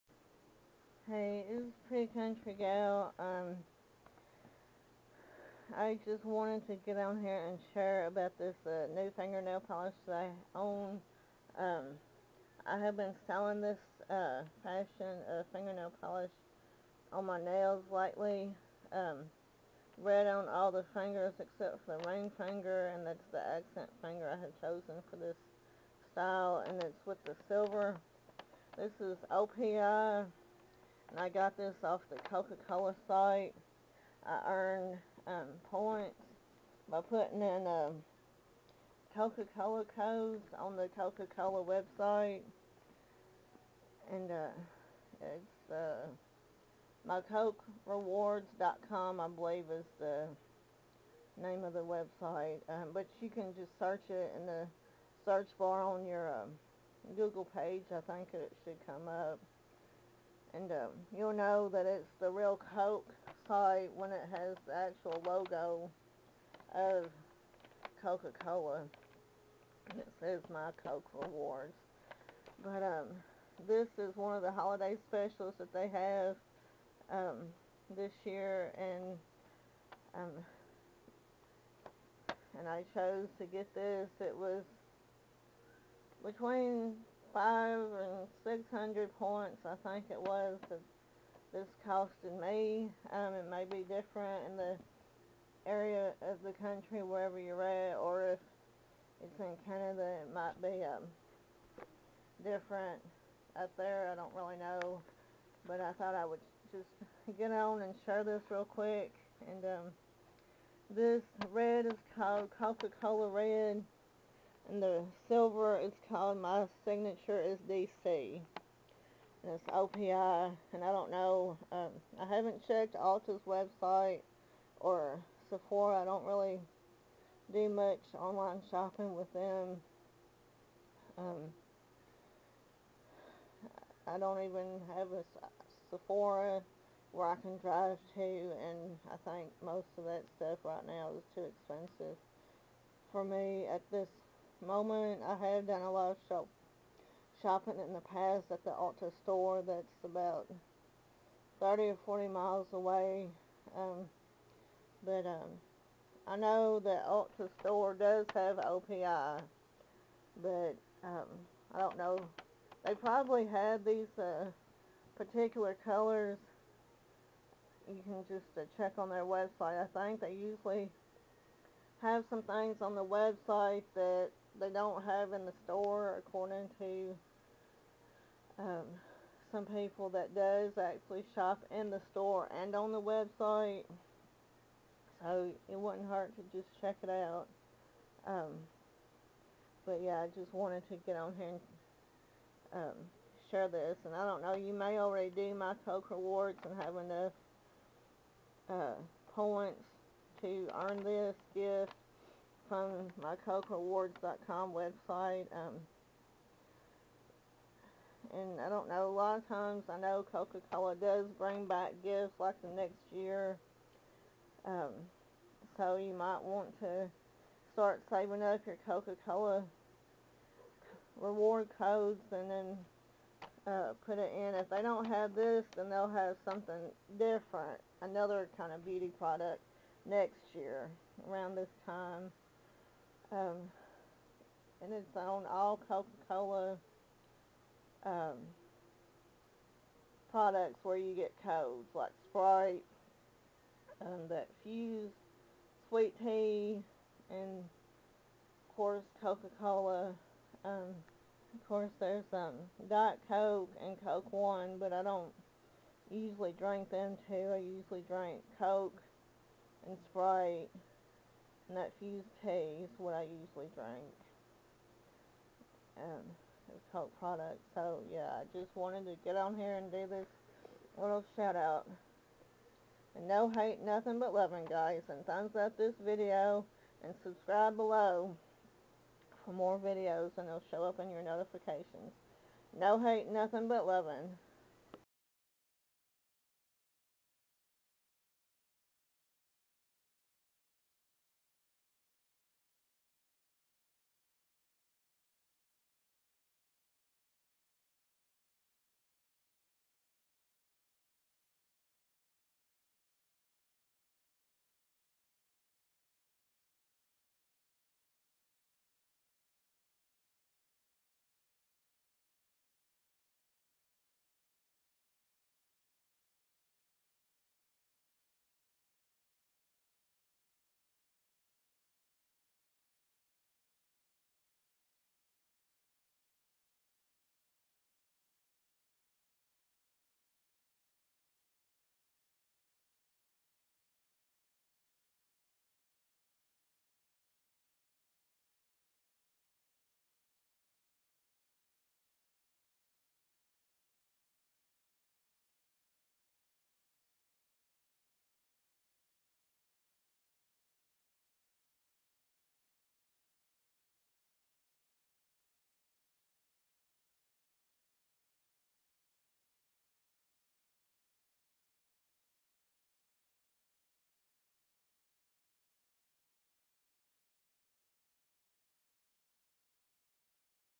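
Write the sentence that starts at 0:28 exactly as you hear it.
This is OPI and I got this off the Coca-Cola site.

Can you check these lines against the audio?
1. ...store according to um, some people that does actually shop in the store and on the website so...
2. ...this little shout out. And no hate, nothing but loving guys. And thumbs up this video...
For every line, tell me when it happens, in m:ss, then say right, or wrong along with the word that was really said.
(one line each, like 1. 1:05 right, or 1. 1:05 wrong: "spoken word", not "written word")
1. 2:55 right
2. 4:30 right.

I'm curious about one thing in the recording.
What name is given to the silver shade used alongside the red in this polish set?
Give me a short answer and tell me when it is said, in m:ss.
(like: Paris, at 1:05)
My Signature is DC, at 1:56.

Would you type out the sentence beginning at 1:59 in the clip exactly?
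And it's OPI, and I don't know, um, I haven't checked Ulta's website or Sephora.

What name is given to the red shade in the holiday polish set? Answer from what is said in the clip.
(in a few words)
Coca-Cola Red.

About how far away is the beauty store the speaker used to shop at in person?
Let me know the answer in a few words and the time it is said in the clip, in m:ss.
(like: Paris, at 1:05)
30 or 40 miles, at 2:31.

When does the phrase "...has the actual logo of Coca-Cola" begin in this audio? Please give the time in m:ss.
1:04.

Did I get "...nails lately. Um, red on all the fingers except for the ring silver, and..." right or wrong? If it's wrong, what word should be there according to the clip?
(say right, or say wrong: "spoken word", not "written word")
wrong: "finger", not "silver".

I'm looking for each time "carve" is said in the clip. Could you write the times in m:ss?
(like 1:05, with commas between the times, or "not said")
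not said.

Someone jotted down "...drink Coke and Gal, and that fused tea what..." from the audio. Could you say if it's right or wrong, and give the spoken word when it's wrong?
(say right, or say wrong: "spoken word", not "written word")
wrong: "Sprite", not "Gal".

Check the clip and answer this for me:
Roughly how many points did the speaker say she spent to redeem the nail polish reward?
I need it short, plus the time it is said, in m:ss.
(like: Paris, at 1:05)
500 to 600, at 1:27.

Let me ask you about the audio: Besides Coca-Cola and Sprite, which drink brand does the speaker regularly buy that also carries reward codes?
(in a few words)
Fuze.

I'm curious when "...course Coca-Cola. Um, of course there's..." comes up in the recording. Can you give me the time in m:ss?
4:08.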